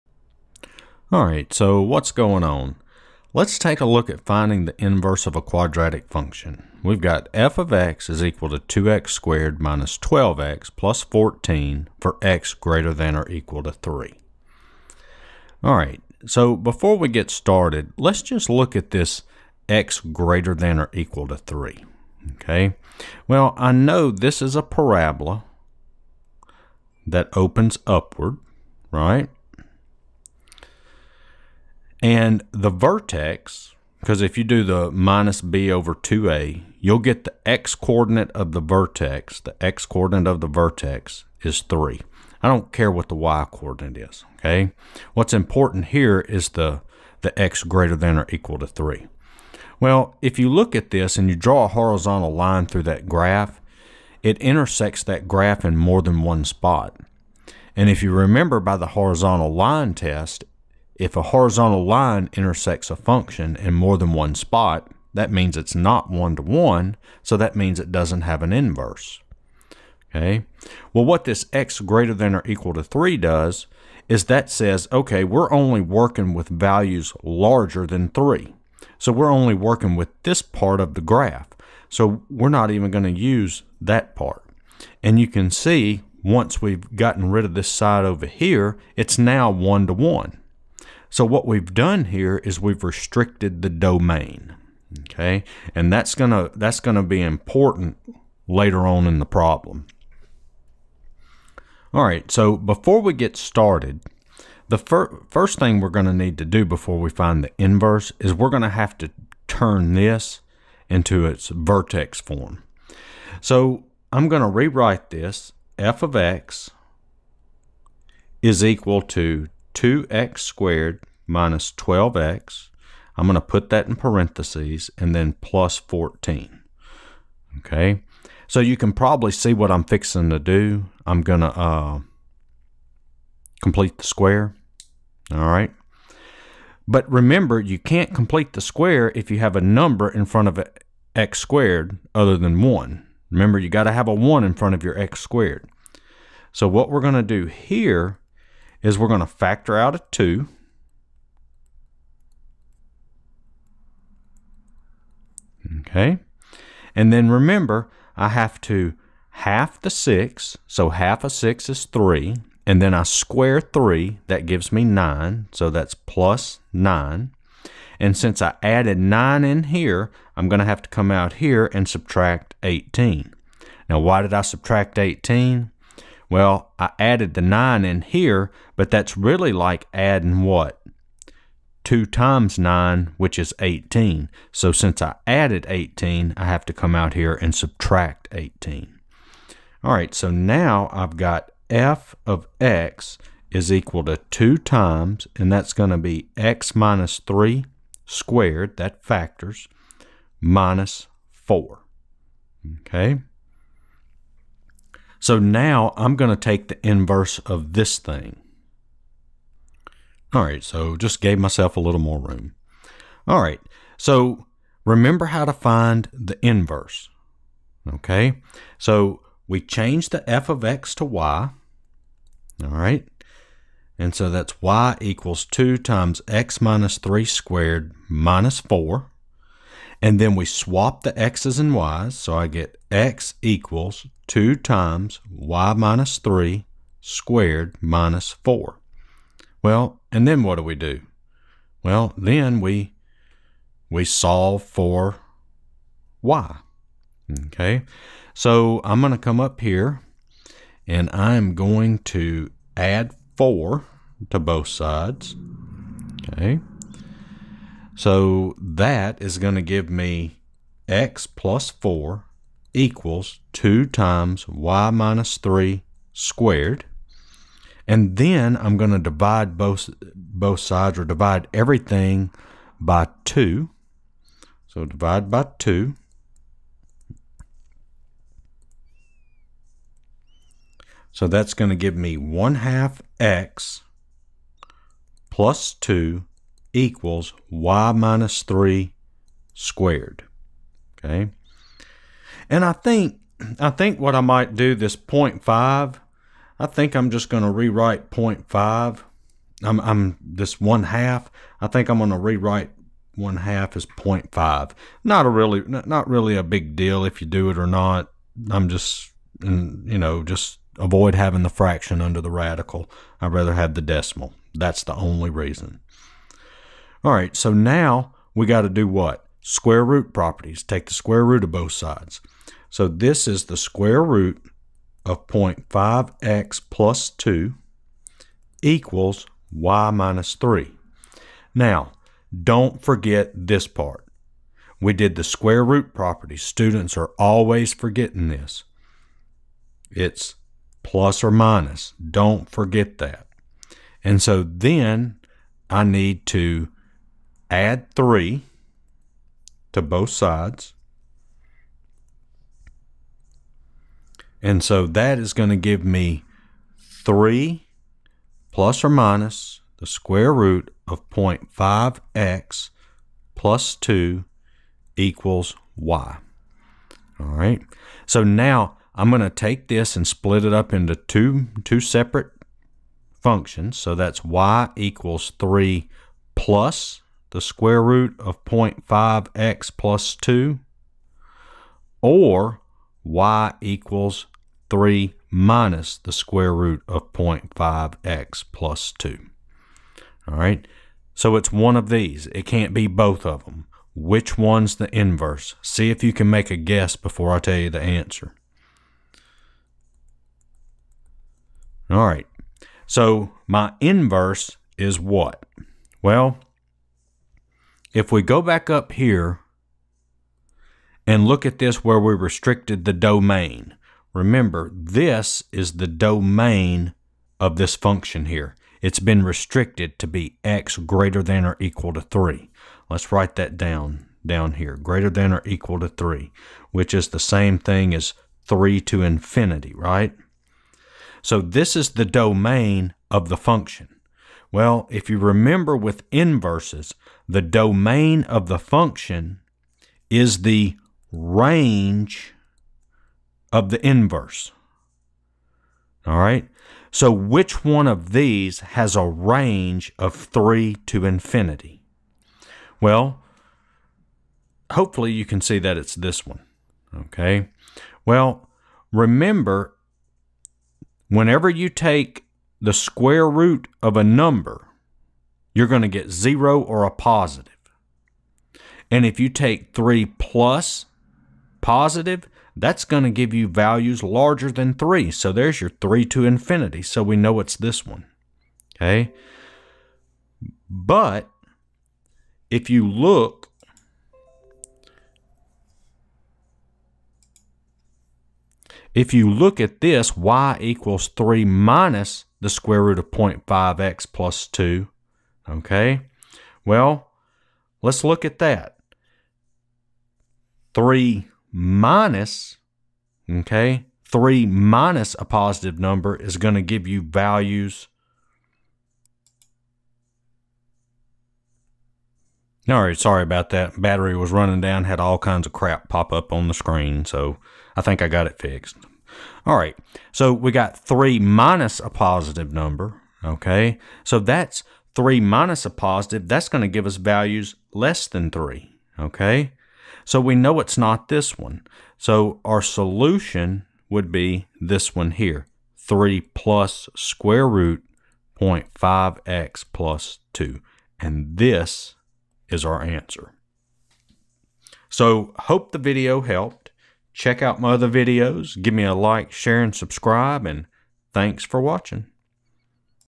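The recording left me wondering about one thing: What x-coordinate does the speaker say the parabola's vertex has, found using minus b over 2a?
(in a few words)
3.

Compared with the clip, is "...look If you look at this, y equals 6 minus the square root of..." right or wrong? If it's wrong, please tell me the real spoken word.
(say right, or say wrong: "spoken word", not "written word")
wrong: "3", not "6".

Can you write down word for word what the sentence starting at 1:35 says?
Okay, and that's gonna that's gonna be important later on in the problem.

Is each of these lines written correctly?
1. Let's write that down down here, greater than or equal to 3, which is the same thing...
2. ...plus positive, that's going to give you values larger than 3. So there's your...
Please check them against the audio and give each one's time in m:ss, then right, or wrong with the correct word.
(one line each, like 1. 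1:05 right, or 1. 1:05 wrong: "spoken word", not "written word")
1. 7:02 right
2. 7:50 right.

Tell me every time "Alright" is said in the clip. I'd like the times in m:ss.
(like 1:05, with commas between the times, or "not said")
0:01, 0:15.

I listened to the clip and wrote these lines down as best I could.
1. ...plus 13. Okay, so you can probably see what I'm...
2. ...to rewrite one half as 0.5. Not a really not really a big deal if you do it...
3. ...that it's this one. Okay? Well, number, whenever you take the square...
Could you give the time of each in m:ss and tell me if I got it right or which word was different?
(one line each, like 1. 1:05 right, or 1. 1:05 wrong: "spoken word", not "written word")
1. 2:05 wrong: "14", not "13"
2. 5:02 right
3. 7:35 wrong: "remember", not "number".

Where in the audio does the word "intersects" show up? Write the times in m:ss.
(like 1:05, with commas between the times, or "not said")
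0:54, 1:02.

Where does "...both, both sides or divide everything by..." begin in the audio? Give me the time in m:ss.
4:29.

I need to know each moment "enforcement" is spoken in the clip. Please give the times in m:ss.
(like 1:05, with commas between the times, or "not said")
not said.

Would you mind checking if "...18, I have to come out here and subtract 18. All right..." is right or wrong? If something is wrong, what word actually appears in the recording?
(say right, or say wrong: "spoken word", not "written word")
right.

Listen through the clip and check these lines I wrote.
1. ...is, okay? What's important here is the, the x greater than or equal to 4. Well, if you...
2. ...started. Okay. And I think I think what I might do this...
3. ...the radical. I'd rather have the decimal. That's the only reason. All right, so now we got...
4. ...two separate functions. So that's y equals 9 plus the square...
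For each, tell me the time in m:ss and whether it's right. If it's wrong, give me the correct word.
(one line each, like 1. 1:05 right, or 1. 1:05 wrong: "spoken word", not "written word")
1. 0:44 wrong: "3", not "4"
2. 4:49 wrong: "squared", not "started"
3. 5:12 right
4. 6:11 wrong: "3", not "9".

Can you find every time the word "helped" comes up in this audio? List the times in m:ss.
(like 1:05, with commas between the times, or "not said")
9:06.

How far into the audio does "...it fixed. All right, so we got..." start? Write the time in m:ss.
8:38.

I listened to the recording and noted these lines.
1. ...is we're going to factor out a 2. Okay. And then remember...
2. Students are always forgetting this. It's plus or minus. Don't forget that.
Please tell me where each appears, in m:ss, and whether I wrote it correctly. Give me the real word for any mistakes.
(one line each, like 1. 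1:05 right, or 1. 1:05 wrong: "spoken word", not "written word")
1. 2:28 right
2. 5:36 right.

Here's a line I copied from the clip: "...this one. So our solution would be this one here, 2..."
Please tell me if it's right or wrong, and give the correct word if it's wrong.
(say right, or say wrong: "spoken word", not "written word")
wrong: "3", not "2".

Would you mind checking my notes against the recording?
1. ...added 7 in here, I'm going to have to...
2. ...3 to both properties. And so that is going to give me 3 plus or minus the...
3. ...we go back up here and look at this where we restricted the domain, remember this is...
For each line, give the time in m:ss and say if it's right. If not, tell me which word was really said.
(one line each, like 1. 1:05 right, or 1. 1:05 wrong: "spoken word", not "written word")
1. 2:48 wrong: "9", not "7"
2. 5:47 wrong: "sides", not "properties"
3. 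6:48 right.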